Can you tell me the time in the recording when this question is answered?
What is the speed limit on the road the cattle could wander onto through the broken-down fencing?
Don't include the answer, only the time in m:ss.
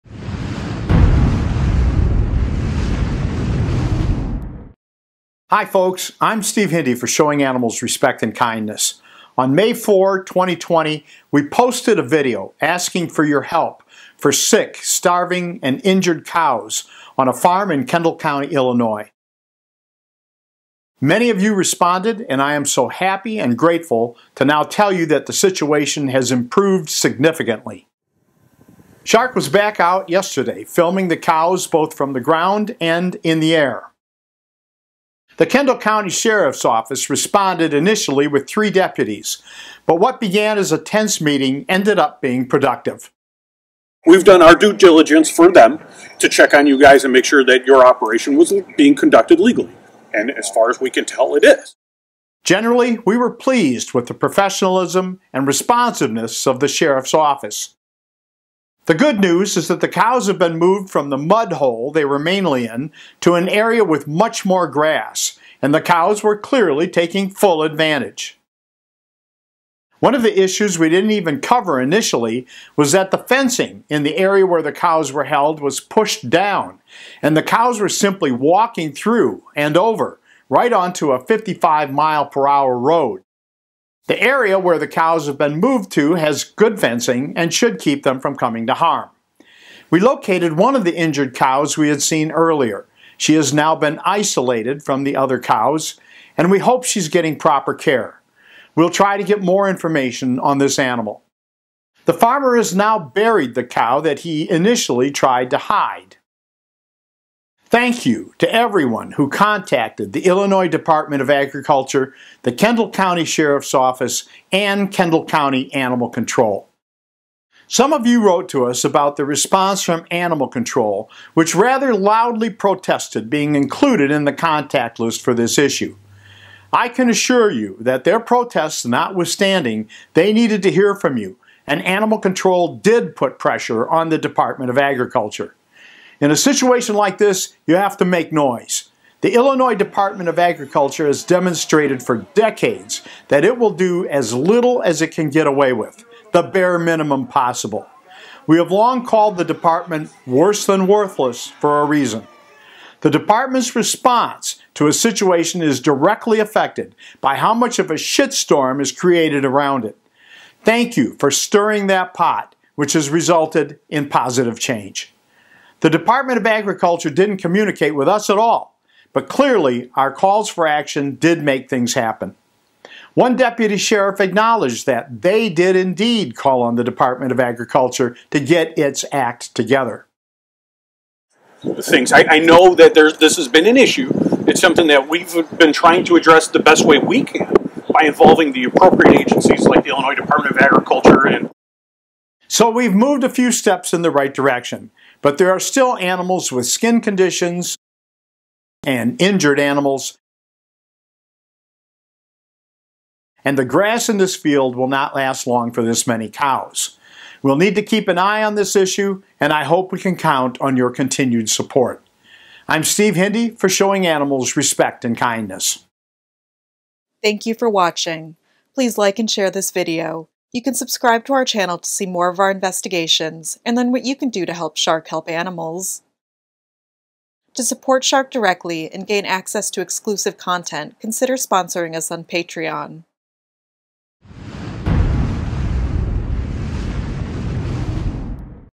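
1:21.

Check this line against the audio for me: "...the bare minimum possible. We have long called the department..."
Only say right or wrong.
right.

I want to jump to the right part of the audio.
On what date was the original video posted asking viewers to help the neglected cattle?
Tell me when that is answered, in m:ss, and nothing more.
0:09.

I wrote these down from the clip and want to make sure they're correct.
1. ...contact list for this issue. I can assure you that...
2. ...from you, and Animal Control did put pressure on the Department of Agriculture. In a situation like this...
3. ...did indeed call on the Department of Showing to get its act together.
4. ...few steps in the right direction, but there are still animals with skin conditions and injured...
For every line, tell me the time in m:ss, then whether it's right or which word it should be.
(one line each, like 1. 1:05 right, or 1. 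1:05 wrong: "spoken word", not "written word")
1. 2:04 right
2. 2:10 right
3. 2:55 wrong: "Agriculture", not "Showing"
4. 3:13 right.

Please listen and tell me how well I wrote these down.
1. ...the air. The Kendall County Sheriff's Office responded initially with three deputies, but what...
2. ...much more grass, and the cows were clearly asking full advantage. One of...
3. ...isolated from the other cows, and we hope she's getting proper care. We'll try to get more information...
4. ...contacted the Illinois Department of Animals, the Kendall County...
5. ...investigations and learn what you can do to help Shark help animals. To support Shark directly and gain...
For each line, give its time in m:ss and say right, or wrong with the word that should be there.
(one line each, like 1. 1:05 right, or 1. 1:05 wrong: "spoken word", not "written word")
1. 0:33 right
2. 1:04 wrong: "taking", not "asking"
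3. 1:34 right
4. 1:49 wrong: "Agriculture", not "Animals"
5. 3:42 right.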